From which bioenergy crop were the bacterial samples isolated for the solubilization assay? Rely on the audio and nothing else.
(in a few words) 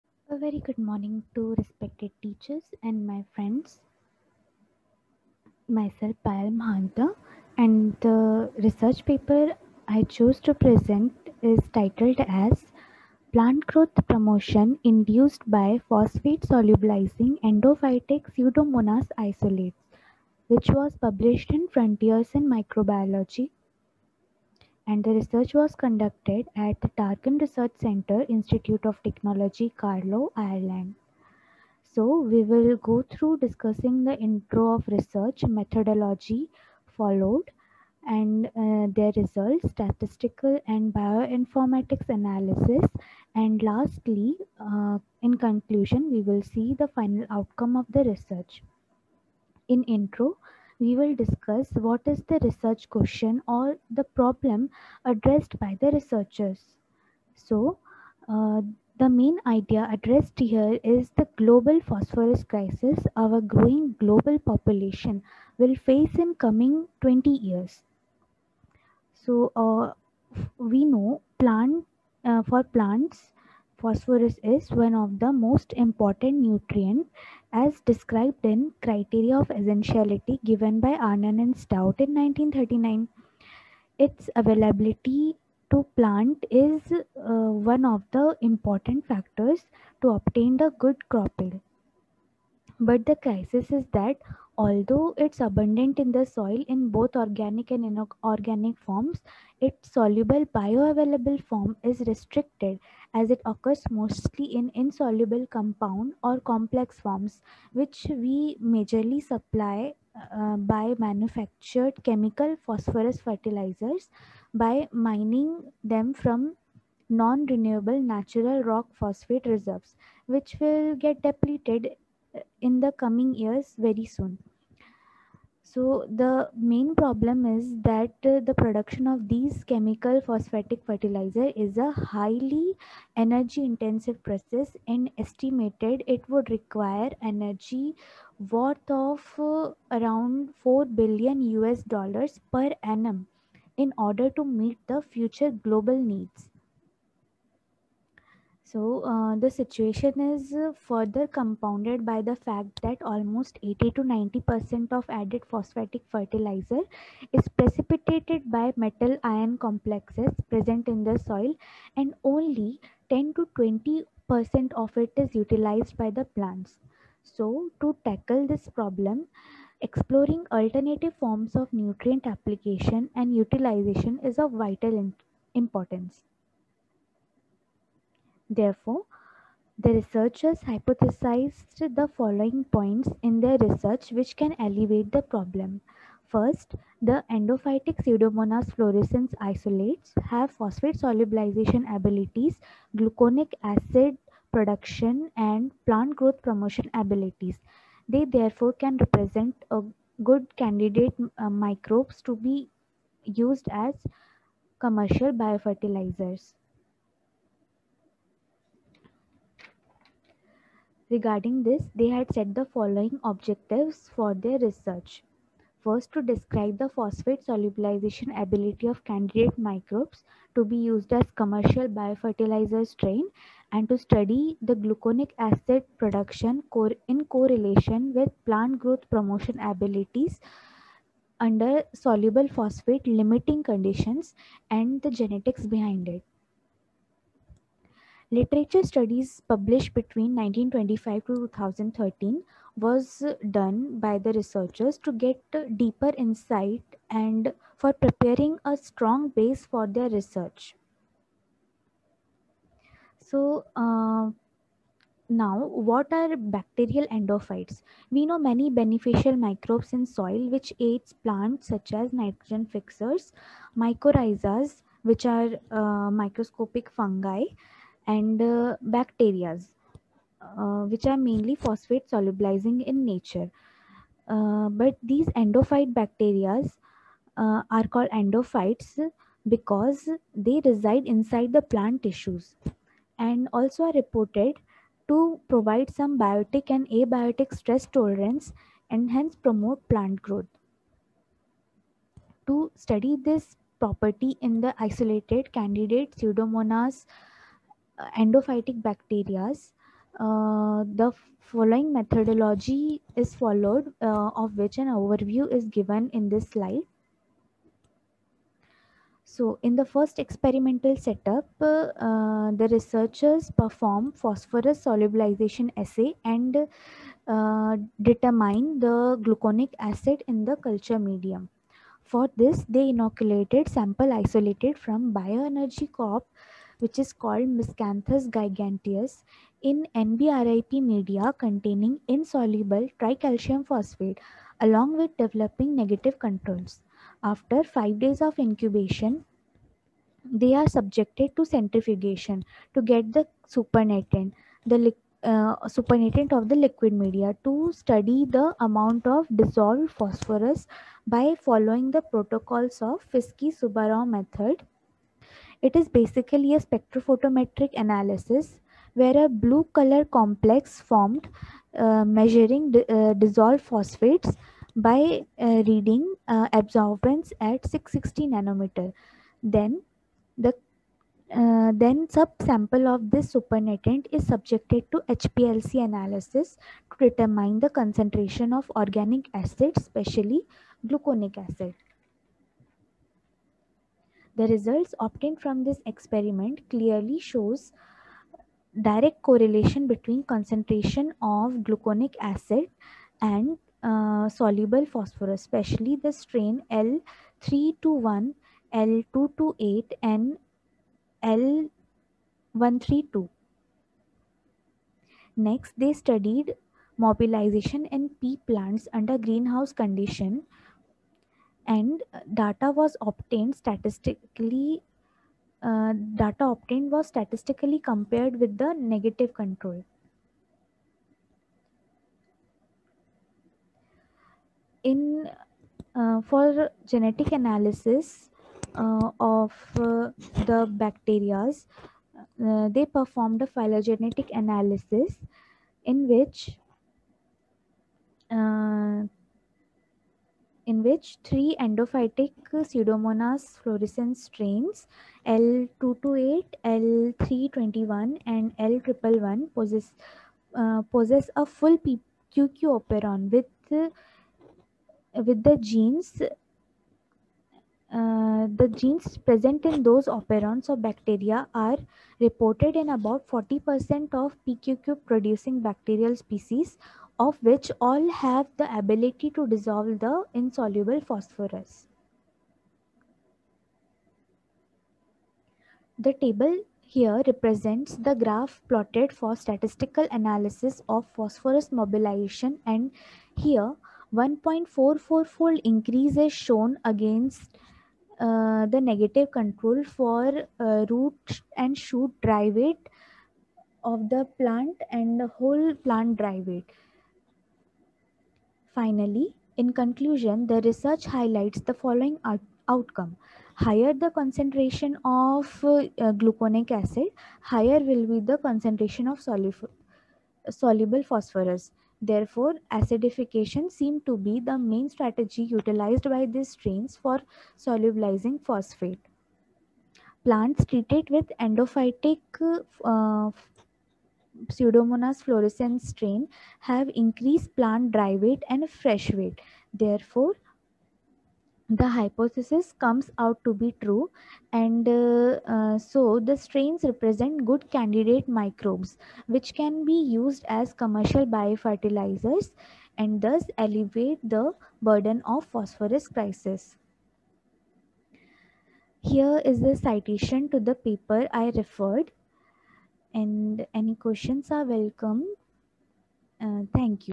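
Miscanthus giganteus.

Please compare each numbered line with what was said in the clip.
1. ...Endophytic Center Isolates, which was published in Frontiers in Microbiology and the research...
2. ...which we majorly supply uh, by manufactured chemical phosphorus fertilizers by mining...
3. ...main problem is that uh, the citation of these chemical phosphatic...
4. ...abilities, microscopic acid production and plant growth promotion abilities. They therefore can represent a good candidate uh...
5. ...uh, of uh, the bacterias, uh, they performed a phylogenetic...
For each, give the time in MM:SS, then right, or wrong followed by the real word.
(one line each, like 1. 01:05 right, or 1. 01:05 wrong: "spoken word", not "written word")
1. 00:17 wrong: "Pseudomonas", not "Center"
2. 01:47 right
3. 02:06 wrong: "production", not "citation"
4. 03:11 wrong: "gluconic", not "microscopic"
5. 07:08 right.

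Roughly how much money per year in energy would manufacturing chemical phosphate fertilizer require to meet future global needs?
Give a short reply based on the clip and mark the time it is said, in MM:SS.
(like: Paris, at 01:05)
4 billion US dollars, at 02:20.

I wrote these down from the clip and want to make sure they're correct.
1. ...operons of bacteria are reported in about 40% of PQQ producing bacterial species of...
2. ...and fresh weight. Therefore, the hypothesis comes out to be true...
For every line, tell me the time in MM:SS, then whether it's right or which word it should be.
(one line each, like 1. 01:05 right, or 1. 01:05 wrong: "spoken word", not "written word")
1. 07:40 right
2. 08:48 right.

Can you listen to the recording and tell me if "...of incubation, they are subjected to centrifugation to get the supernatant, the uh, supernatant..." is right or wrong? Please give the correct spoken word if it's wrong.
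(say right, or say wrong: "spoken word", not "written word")
right.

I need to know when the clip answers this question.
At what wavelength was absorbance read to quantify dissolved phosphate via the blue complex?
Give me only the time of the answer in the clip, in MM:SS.
06:07.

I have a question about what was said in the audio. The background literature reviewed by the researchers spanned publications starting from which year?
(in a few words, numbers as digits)
1925.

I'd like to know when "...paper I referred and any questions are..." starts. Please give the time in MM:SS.
09:10.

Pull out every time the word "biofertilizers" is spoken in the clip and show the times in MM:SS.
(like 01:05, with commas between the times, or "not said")
03:25, 03:41, 09:01.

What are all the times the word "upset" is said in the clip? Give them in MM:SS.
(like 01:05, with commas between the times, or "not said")
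not said.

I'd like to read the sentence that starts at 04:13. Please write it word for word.
So uh, now, what are bacterial endophytes?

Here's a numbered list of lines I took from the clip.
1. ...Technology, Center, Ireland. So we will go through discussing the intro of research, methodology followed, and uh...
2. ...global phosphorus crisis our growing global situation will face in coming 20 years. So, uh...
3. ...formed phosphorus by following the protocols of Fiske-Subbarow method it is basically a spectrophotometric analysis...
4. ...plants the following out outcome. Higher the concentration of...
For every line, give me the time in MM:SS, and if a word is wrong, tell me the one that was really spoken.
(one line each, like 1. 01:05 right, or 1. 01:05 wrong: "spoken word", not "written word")
1. 00:29 wrong: "Carlow", not "Center"
2. 01:01 wrong: "population", not "situation"
3. 05:49 wrong: "dissolved", not "formed"
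4. 08:21 wrong: "highlights", not "plants".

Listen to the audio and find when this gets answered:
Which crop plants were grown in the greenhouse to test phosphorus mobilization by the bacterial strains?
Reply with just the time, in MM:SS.
06:48.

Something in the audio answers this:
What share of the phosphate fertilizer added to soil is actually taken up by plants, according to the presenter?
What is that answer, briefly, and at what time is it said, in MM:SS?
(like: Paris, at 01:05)
10 to 20%, at 02:43.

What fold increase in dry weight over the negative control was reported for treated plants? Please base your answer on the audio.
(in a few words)
1.44.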